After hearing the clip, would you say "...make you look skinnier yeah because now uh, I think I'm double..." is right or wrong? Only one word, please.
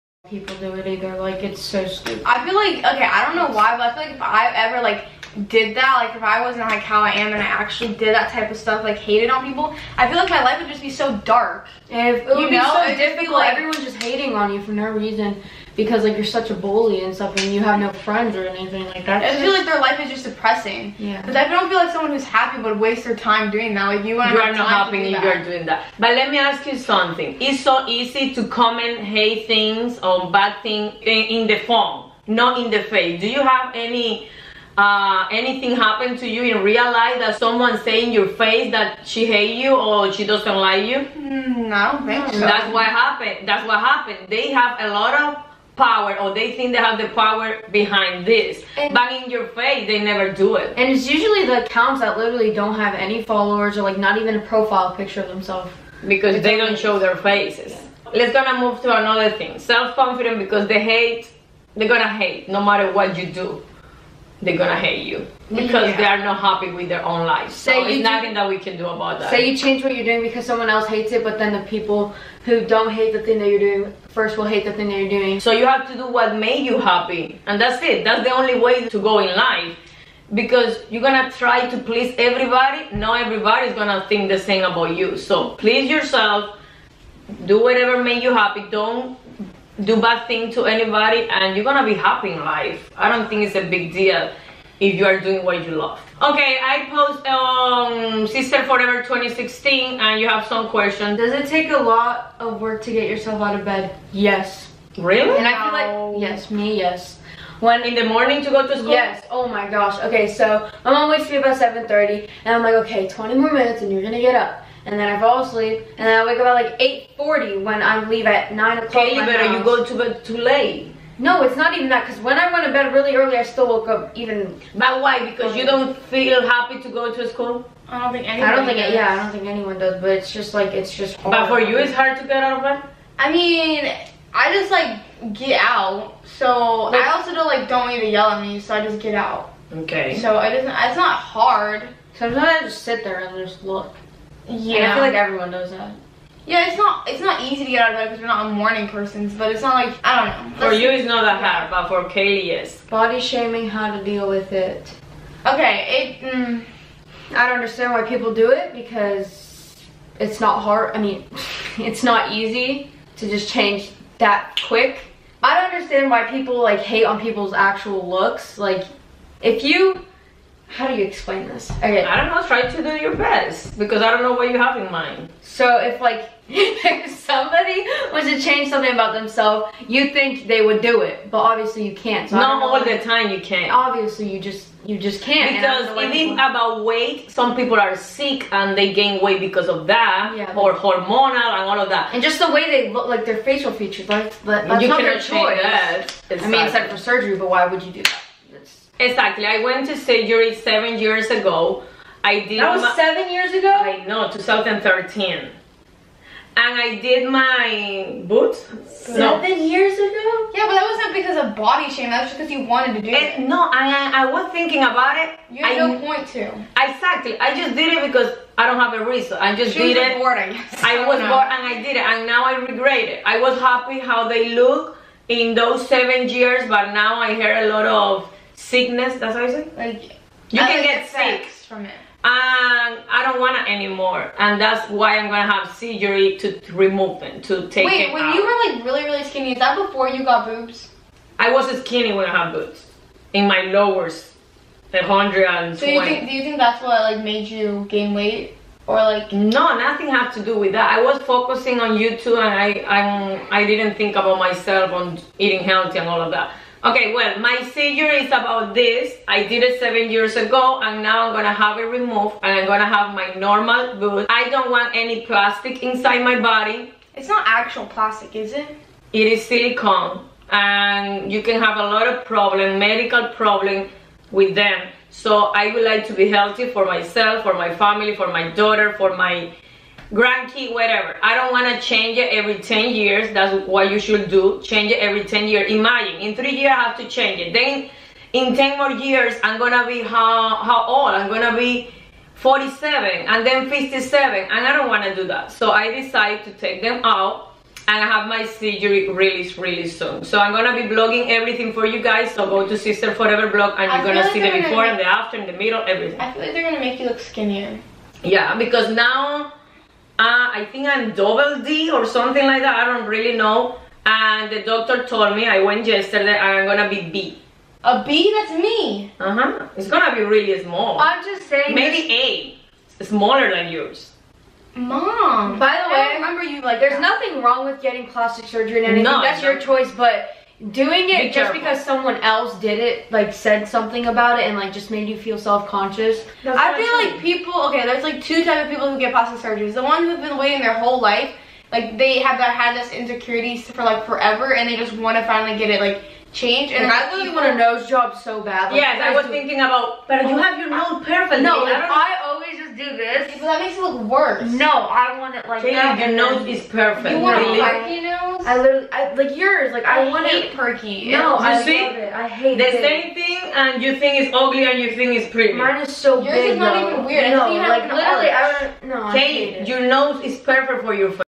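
right.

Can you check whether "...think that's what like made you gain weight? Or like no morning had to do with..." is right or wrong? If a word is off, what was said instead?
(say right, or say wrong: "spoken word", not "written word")
wrong: "nothing", not "morning".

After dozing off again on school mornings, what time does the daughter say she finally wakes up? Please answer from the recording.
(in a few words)
8:40.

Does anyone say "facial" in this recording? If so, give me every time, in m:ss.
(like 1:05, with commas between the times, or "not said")
3:13.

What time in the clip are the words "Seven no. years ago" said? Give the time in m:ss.
3:28.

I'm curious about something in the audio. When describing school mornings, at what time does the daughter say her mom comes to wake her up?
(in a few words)
7:30.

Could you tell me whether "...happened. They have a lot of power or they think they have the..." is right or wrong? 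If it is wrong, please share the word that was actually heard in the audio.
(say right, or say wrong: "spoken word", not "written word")
right.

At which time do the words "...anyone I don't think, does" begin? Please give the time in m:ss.
2:08.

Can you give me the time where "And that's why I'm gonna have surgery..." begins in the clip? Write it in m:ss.
3:54.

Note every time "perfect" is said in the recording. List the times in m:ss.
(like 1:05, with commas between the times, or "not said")
5:51, 5:56, 6:10.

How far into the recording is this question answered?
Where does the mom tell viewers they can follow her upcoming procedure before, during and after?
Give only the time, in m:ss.
5:02.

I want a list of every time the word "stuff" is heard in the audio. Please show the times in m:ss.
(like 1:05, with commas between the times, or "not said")
0:08, 0:17.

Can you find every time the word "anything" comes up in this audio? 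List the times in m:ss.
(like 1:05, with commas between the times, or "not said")
0:18, 0:35, 5:28.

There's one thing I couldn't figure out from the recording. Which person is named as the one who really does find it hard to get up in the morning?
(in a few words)
Kaylee.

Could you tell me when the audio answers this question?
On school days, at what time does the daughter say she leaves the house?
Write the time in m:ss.
1:58.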